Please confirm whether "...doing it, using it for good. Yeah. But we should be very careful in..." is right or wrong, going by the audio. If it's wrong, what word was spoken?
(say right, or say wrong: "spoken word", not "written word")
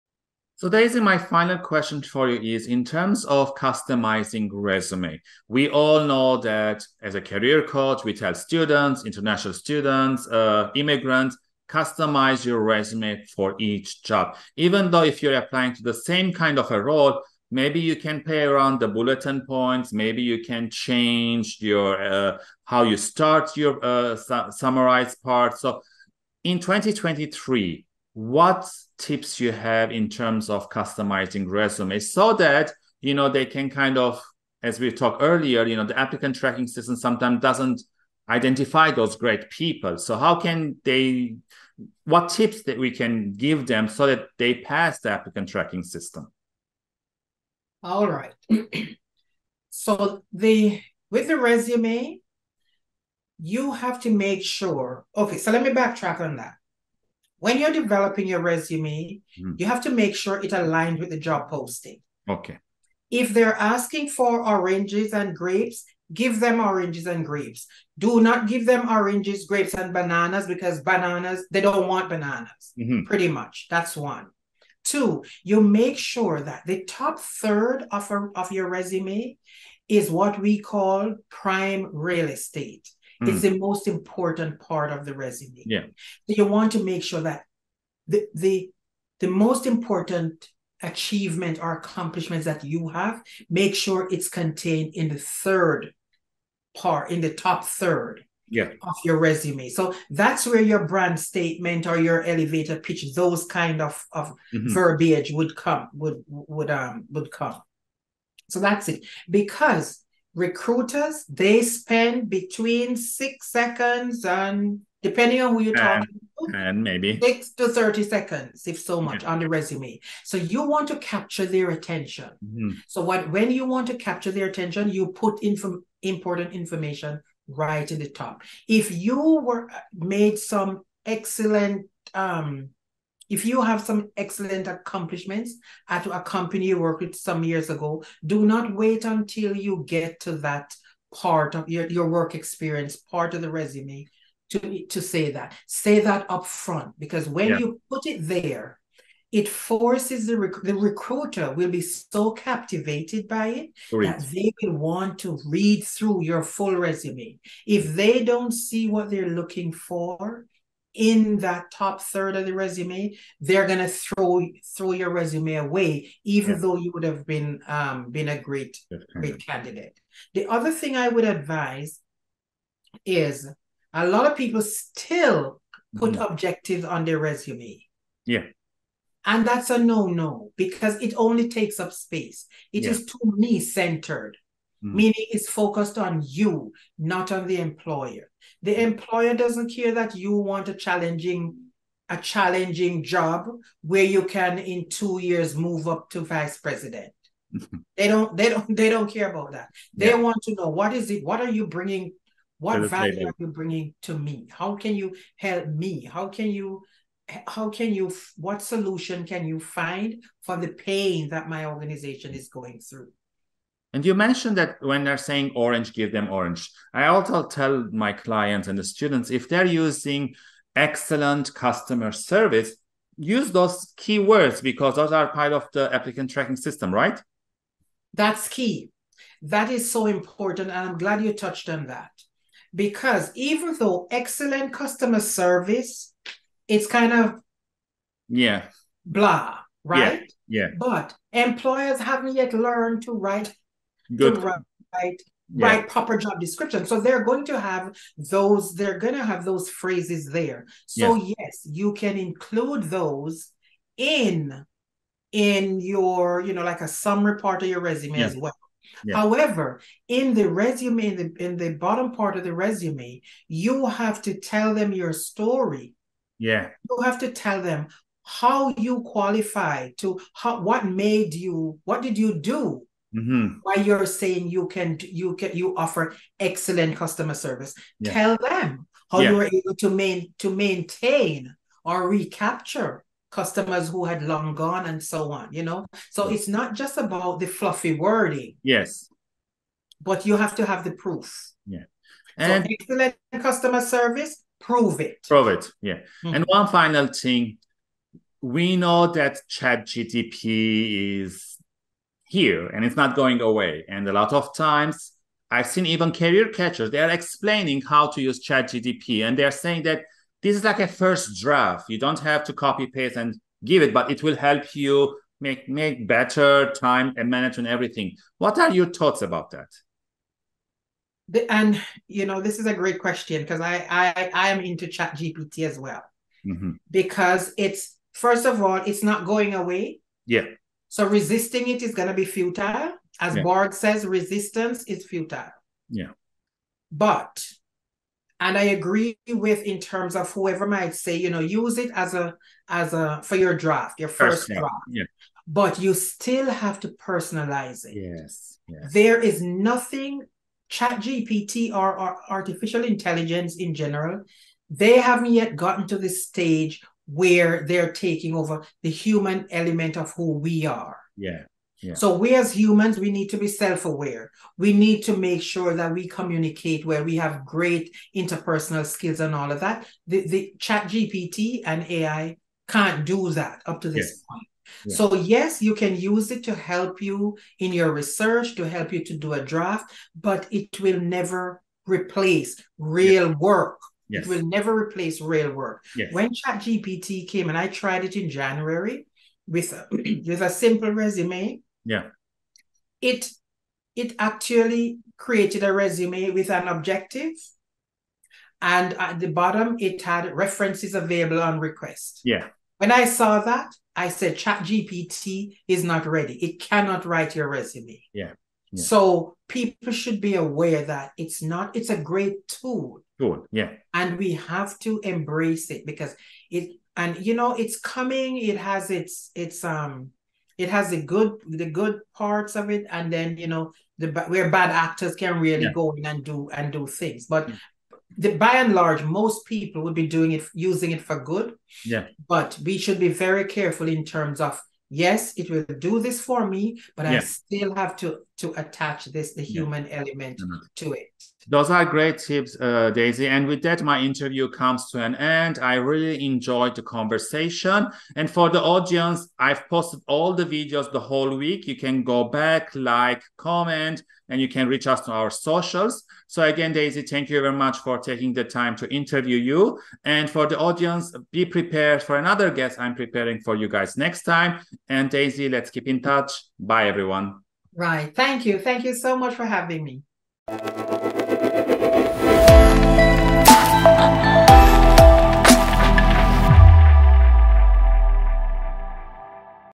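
right.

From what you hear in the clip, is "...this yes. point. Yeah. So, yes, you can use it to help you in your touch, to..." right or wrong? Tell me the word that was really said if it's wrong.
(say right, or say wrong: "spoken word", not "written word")
wrong: "research", not "touch".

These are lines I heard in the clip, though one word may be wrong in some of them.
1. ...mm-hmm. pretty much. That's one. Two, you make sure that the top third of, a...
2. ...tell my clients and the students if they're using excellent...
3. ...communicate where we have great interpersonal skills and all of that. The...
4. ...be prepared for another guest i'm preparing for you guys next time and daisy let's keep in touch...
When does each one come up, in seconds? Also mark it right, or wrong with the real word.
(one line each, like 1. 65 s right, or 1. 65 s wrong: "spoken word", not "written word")
1. 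72 s right
2. 217 s right
3. 366 s right
4. 461 s right.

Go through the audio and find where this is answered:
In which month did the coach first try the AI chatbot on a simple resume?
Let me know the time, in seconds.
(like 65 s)
388 s.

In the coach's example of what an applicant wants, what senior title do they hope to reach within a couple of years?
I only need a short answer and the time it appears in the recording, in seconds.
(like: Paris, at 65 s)
vice president, at 196 s.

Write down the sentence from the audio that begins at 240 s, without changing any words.
but employers haven't yet learned to write Good.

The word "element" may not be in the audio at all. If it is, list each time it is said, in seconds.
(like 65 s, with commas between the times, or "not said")
359 s, 439 s.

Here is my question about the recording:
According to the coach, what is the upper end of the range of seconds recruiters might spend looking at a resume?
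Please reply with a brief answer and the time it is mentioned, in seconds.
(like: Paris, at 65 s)
30, at 117 s.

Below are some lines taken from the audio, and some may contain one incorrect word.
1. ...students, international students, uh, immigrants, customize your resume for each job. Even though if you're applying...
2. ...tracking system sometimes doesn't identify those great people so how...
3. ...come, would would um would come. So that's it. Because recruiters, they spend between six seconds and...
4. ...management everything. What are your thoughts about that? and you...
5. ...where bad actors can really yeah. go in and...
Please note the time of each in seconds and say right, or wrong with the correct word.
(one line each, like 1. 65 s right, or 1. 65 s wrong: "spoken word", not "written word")
1. 8 s right
2. 36 s right
3. 105 s right
4. 317 s right
5. 424 s right.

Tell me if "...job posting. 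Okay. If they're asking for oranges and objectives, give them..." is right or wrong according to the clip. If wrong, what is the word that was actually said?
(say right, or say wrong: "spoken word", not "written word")
wrong: "grapes", not "objectives".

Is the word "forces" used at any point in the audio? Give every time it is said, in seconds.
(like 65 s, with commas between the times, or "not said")
149 s.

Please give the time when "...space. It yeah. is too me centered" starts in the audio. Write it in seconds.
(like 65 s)
181 s.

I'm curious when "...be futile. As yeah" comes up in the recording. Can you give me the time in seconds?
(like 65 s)
332 s.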